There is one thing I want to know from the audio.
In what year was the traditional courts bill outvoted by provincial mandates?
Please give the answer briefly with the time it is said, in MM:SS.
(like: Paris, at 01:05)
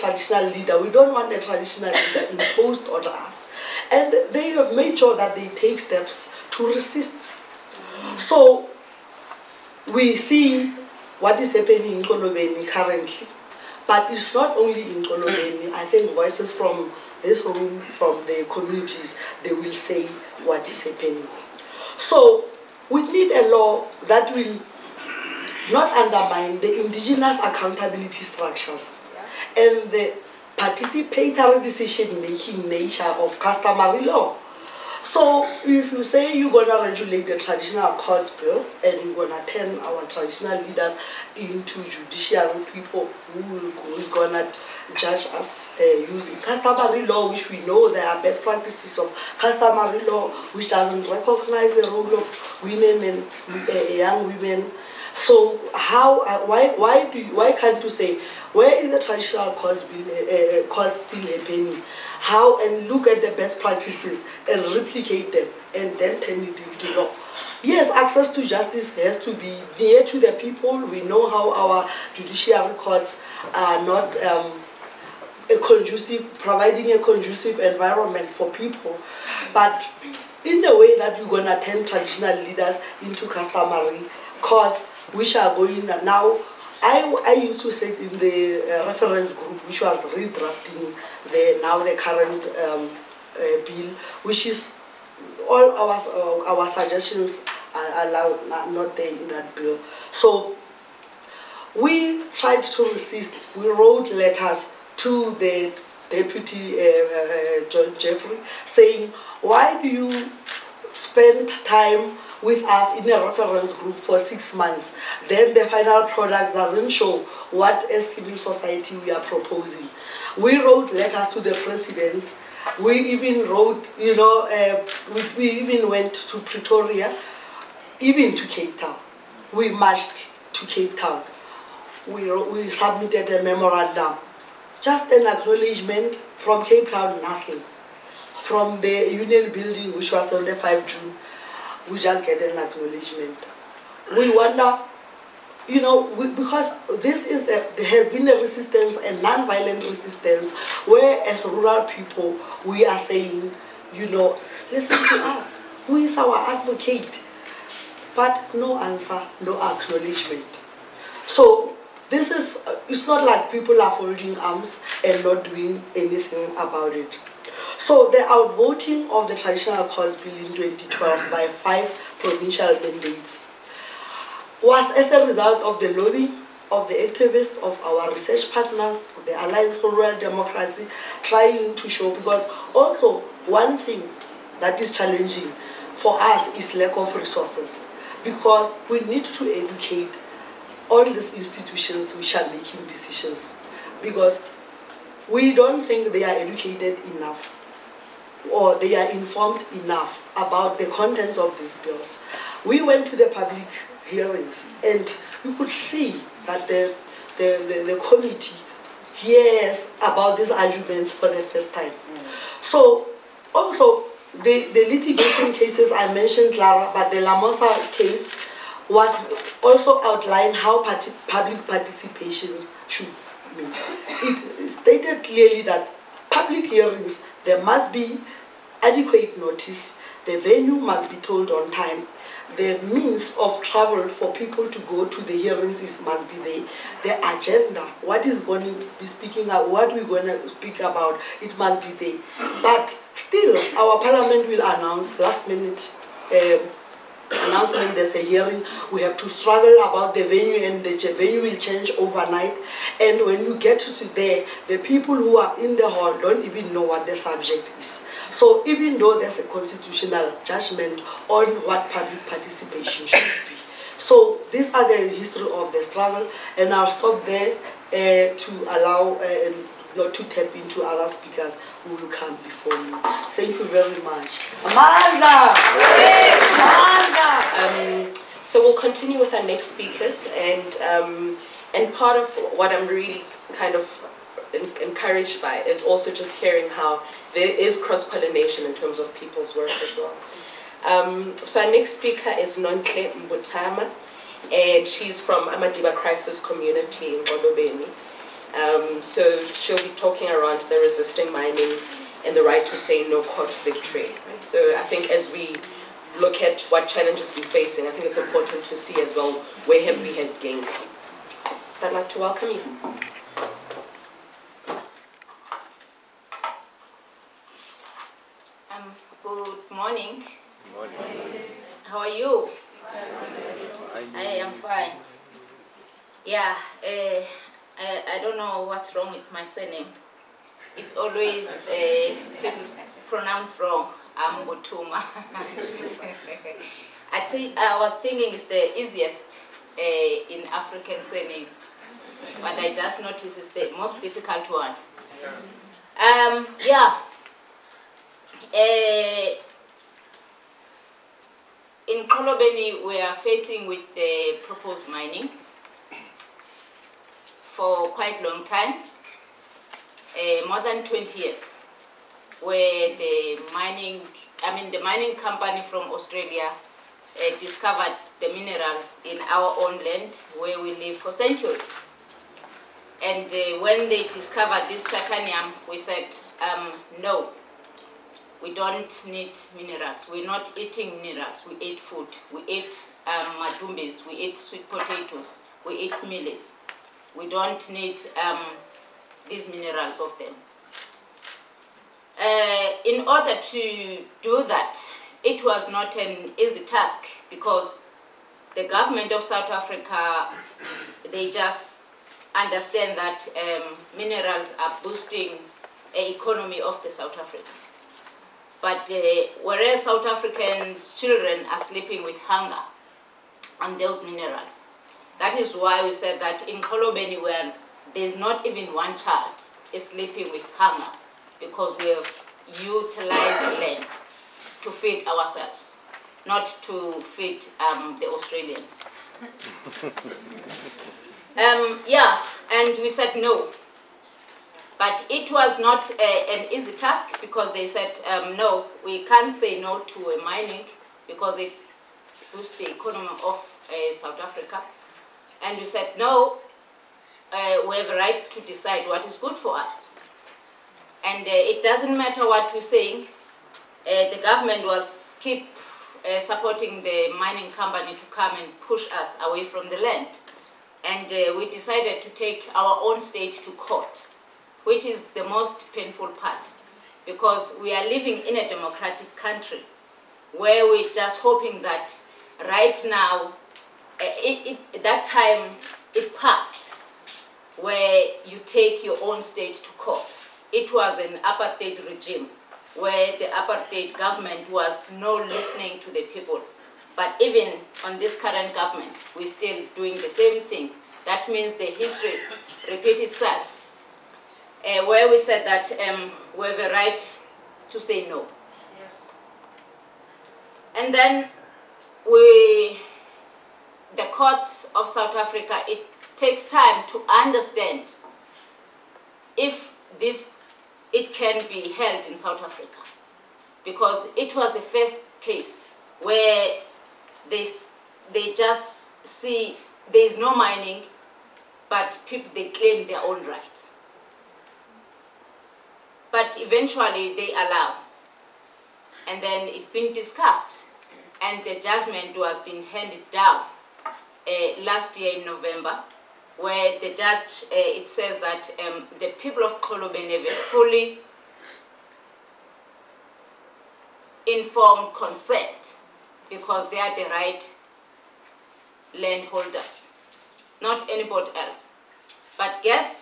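2012, at 02:50.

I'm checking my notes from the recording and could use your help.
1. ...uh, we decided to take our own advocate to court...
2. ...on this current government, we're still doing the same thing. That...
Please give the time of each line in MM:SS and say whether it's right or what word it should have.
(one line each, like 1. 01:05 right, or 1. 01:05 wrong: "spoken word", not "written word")
1. 07:41 wrong: "state", not "advocate"
2. 08:07 right.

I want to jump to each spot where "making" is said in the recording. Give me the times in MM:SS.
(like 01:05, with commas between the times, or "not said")
00:31, 03:12.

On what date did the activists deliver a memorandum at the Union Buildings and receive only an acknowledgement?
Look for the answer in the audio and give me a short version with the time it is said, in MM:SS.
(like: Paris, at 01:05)
5 June, at 02:20.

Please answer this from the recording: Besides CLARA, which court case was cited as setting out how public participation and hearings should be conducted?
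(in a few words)
LAMOSA.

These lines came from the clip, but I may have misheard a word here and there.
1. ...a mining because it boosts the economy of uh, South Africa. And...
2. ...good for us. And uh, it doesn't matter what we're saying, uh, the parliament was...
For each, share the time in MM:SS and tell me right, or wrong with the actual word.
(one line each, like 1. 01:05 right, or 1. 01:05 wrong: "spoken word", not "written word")
1. 07:20 right
2. 07:29 wrong: "government", not "parliament".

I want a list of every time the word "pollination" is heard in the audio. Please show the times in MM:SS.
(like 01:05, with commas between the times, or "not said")
04:48.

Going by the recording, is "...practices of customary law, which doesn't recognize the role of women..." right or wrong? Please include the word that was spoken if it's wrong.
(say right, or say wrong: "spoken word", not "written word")
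right.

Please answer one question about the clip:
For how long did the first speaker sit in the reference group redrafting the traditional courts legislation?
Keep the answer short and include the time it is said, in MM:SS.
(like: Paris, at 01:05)
six months, at 01:54.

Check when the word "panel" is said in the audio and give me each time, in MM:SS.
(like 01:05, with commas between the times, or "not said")
not said.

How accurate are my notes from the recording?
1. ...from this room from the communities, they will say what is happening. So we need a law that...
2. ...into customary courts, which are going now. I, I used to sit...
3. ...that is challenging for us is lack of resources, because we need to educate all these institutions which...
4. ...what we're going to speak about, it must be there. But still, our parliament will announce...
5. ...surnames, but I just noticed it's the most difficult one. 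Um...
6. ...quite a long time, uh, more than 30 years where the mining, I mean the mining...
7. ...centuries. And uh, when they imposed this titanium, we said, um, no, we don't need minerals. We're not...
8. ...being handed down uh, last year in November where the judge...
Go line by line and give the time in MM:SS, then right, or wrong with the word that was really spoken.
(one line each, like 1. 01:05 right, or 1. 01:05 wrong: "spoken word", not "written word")
1. 00:16 right
2. 01:23 right
3. 03:04 right
4. 03:59 right
5. 05:41 right
6. 05:57 wrong: "20", not "30"
7. 06:11 wrong: "discovered", not "imposed"
8. 08:52 right.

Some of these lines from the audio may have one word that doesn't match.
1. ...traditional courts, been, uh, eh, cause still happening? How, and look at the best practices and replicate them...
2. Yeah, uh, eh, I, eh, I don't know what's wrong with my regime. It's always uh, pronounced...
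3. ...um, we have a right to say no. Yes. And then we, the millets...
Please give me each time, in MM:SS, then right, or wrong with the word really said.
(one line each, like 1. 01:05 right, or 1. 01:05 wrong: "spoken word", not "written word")
1. 00:59 right
2. 05:26 wrong: "surname", not "regime"
3. 08:15 wrong: "courts", not "millets".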